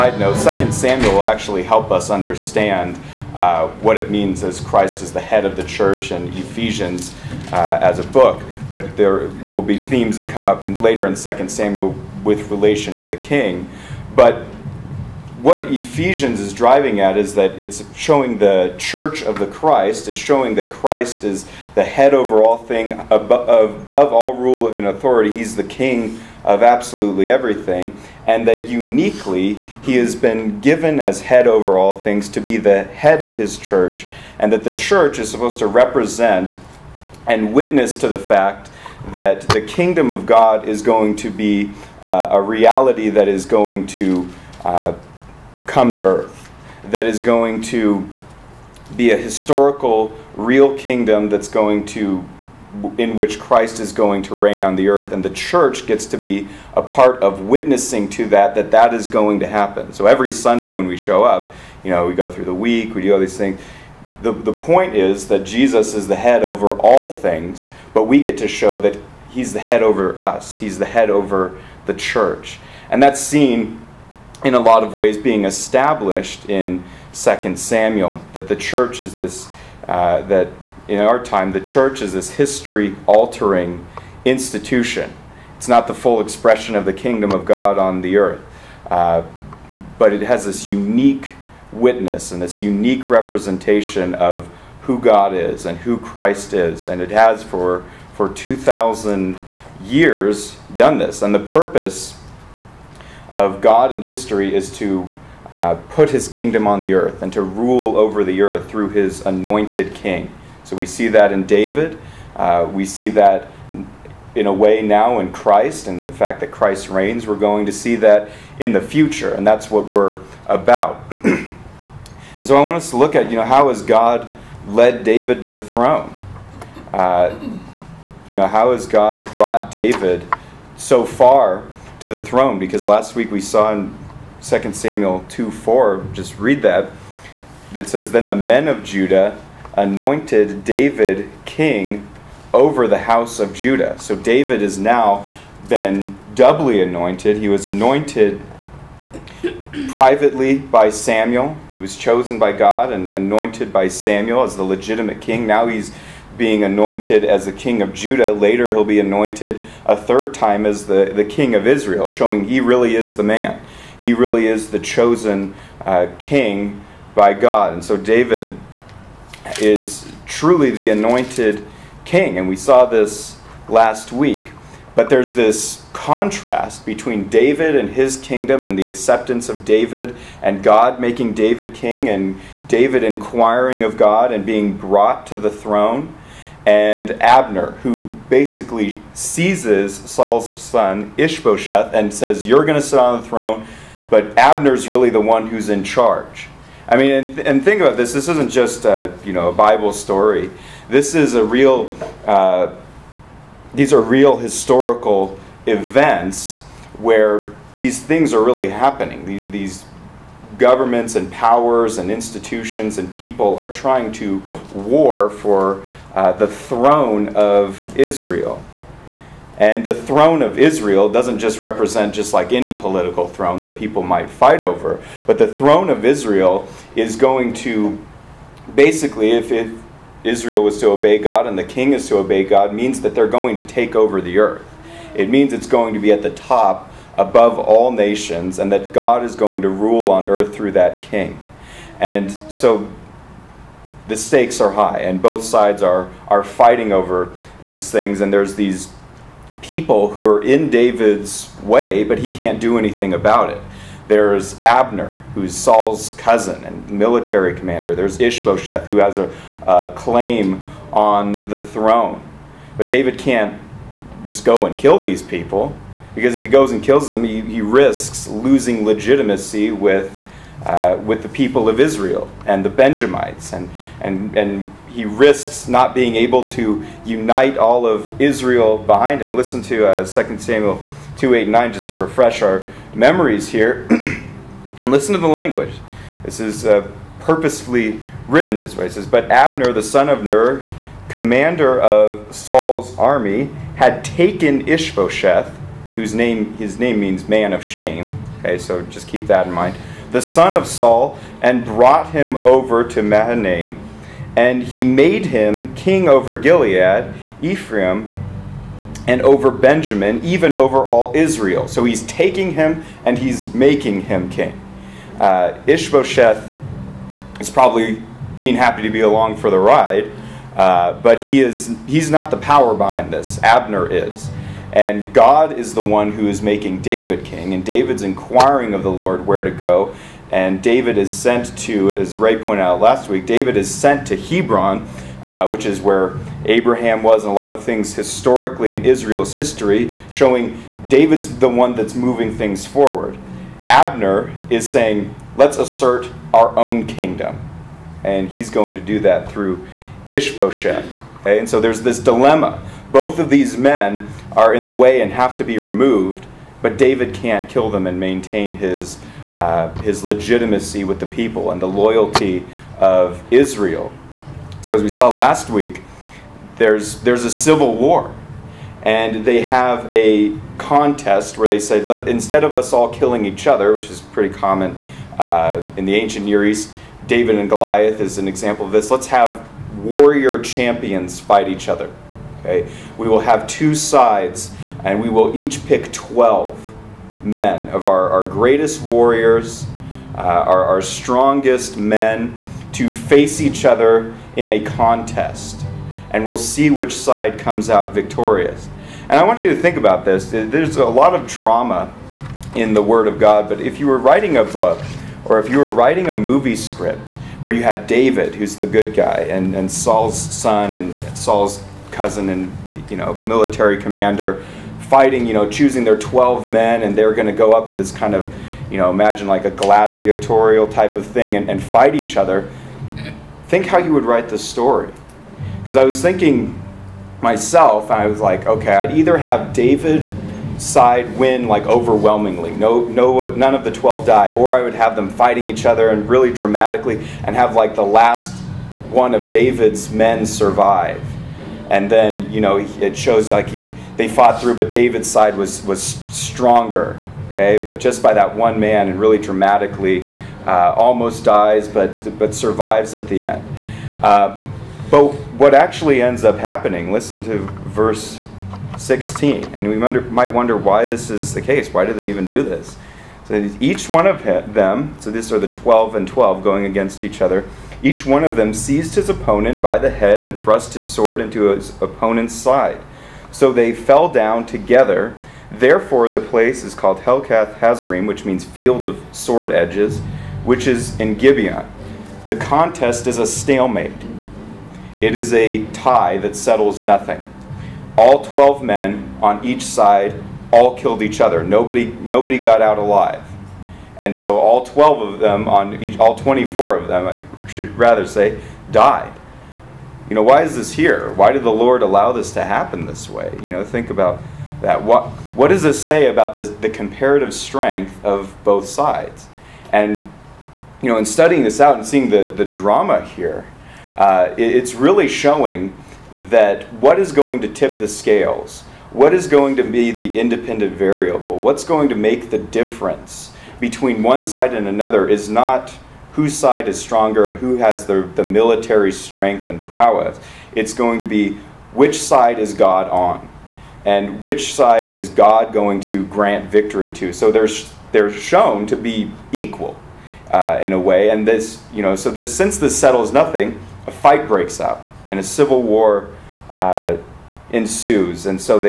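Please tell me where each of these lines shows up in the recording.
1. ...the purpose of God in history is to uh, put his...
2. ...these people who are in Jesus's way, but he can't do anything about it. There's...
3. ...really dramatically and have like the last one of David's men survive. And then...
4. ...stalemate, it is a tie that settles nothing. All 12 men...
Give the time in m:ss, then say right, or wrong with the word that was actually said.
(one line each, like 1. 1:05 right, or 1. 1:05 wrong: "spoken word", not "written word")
1. 1:41 right
2. 4:08 wrong: "David", not "Jesus"
3. 7:16 right
4. 8:03 right.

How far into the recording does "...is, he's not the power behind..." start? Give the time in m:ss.
5:21.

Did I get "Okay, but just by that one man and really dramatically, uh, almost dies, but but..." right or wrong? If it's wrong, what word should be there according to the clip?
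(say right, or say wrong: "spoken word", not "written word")
right.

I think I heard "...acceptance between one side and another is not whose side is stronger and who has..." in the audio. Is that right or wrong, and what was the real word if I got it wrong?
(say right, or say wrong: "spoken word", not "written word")
wrong: "difference", not "acceptance".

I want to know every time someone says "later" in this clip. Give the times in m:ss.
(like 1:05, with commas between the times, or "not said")
0:10, 2:38.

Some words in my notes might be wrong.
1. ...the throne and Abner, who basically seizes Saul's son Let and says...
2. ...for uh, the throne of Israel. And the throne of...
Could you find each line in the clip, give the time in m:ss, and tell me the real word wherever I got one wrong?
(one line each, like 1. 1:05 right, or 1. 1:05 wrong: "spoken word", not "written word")
1. 3:05 wrong: "Ishbosheth", not "Let"
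2. 3:35 right.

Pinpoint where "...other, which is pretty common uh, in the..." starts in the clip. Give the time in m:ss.
6:13.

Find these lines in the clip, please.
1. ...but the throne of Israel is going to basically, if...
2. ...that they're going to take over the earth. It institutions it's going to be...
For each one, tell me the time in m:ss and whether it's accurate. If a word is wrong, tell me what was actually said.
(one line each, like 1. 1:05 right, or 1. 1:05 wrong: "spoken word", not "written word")
1. 3:45 right
2. 3:53 wrong: "means", not "institutions".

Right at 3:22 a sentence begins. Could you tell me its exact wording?
Uh, these are real historical events where these things are really happening.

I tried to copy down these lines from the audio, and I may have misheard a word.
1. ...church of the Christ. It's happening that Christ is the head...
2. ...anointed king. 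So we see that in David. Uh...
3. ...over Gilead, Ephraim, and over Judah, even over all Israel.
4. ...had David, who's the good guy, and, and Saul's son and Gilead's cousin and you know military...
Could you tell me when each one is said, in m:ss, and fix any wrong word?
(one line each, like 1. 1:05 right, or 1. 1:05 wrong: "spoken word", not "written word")
1. 0:18 wrong: "showing", not "happening"
2. 1:49 right
3. 5:06 wrong: "Benjamin", not "Judah"
4. 6:47 wrong: "Saul", not "Gilead".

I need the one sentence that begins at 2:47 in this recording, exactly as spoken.
And so David is truly the anointed king.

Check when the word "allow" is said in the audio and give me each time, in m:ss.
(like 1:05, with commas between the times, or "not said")
8:21.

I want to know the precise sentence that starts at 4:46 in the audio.
This is uh, purposefully written this way.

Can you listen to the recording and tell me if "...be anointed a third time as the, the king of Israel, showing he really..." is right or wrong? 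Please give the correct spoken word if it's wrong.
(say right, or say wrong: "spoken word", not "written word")
right.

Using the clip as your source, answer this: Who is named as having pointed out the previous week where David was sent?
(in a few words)
Ray.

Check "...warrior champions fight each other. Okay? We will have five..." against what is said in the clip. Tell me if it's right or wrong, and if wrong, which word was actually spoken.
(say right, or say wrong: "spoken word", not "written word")
wrong: "two", not "five".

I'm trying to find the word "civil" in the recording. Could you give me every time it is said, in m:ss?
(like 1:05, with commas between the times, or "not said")
6:07, 9:05.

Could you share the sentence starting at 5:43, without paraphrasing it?
Abner is saying, let's assert our own kingdom.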